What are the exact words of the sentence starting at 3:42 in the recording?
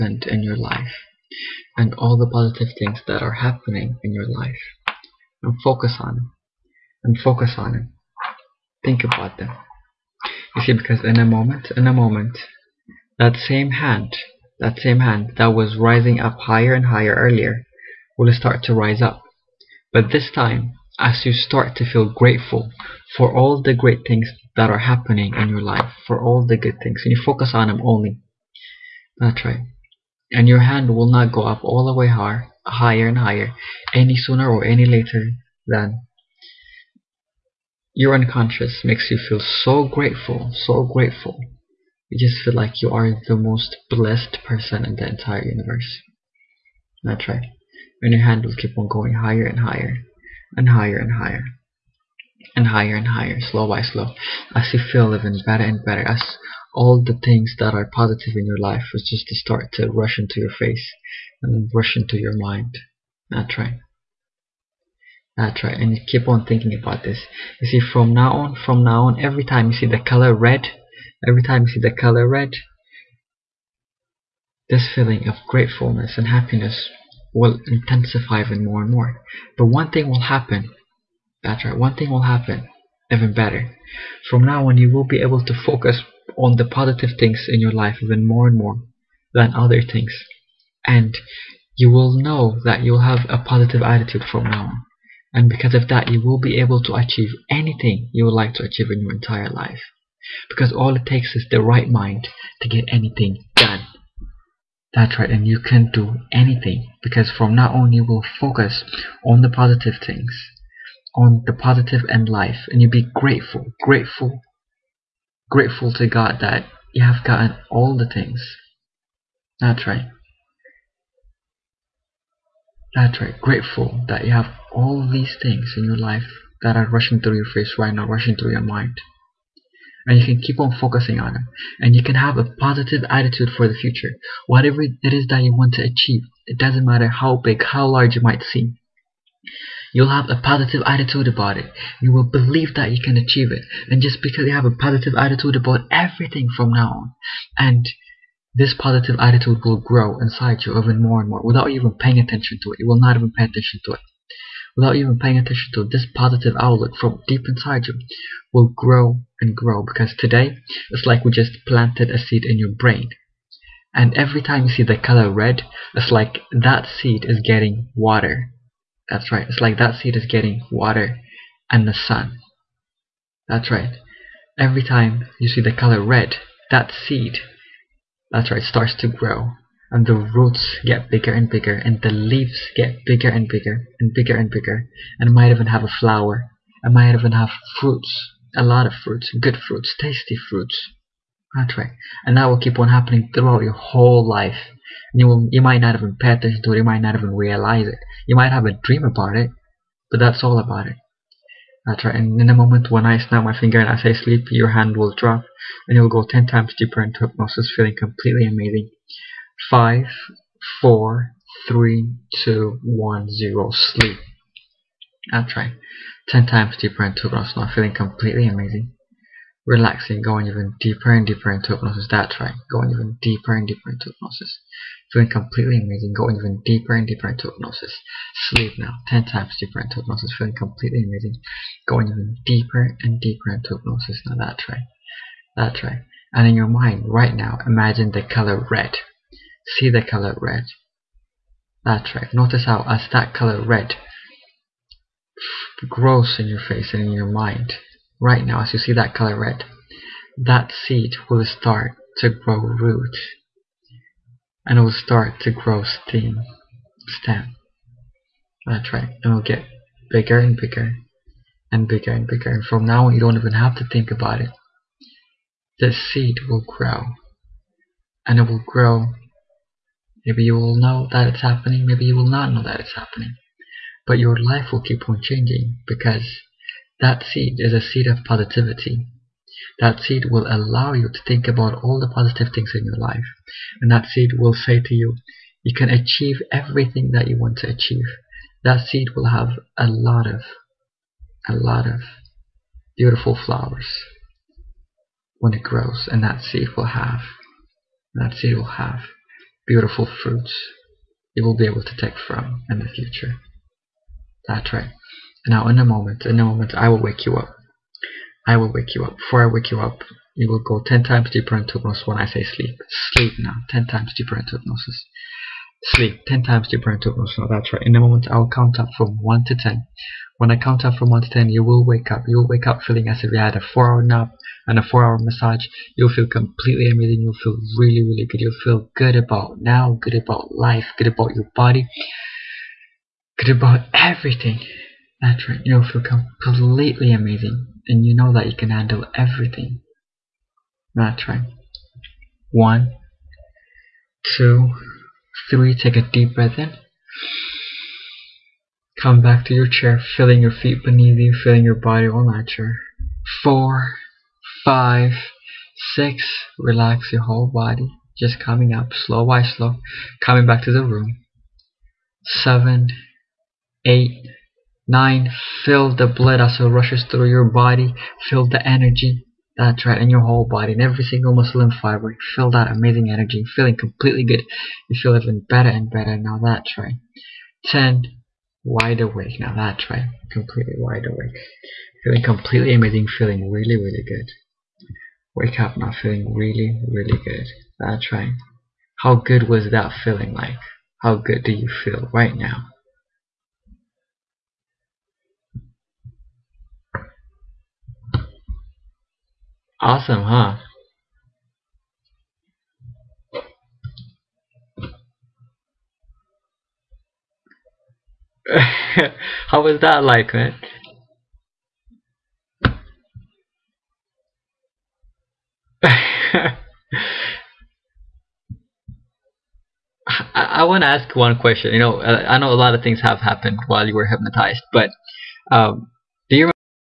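That's right, going even deeper and deeper into hypnosis feeling completely amazing, going even deeper and deeper into hypnosis.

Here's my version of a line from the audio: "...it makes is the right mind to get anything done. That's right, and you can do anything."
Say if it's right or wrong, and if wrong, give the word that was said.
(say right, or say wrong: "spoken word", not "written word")
wrong: "takes", not "makes".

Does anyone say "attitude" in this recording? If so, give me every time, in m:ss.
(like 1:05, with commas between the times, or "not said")
1:33, 2:13, 2:20, 2:25, 2:29.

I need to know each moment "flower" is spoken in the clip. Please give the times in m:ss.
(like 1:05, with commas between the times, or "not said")
3:05, 4:53.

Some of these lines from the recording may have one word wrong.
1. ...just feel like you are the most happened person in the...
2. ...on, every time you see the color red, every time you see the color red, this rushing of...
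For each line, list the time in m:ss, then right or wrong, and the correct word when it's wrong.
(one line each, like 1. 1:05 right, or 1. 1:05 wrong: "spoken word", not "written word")
1. 0:42 wrong: "blessed", not "happened"
2. 1:09 wrong: "feeling", not "rushing".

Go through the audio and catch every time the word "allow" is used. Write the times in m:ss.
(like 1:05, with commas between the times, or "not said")
4:40.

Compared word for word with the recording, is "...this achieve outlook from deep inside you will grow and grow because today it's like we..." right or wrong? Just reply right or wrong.
wrong.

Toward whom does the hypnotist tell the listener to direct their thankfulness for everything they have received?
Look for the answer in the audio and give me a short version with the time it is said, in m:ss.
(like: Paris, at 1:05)
God, at 1:56.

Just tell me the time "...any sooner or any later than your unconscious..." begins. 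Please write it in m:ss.
0:33.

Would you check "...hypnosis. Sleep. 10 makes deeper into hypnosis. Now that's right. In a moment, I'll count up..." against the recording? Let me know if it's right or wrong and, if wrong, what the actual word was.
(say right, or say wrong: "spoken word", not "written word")
wrong: "times", not "makes".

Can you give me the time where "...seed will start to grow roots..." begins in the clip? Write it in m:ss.
4:10.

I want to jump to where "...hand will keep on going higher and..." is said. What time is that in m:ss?
0:48.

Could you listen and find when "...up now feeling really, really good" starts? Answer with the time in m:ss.
6:25.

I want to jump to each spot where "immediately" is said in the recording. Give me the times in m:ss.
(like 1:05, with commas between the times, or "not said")
not said.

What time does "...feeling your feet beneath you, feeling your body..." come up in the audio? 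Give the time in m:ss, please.
5:50.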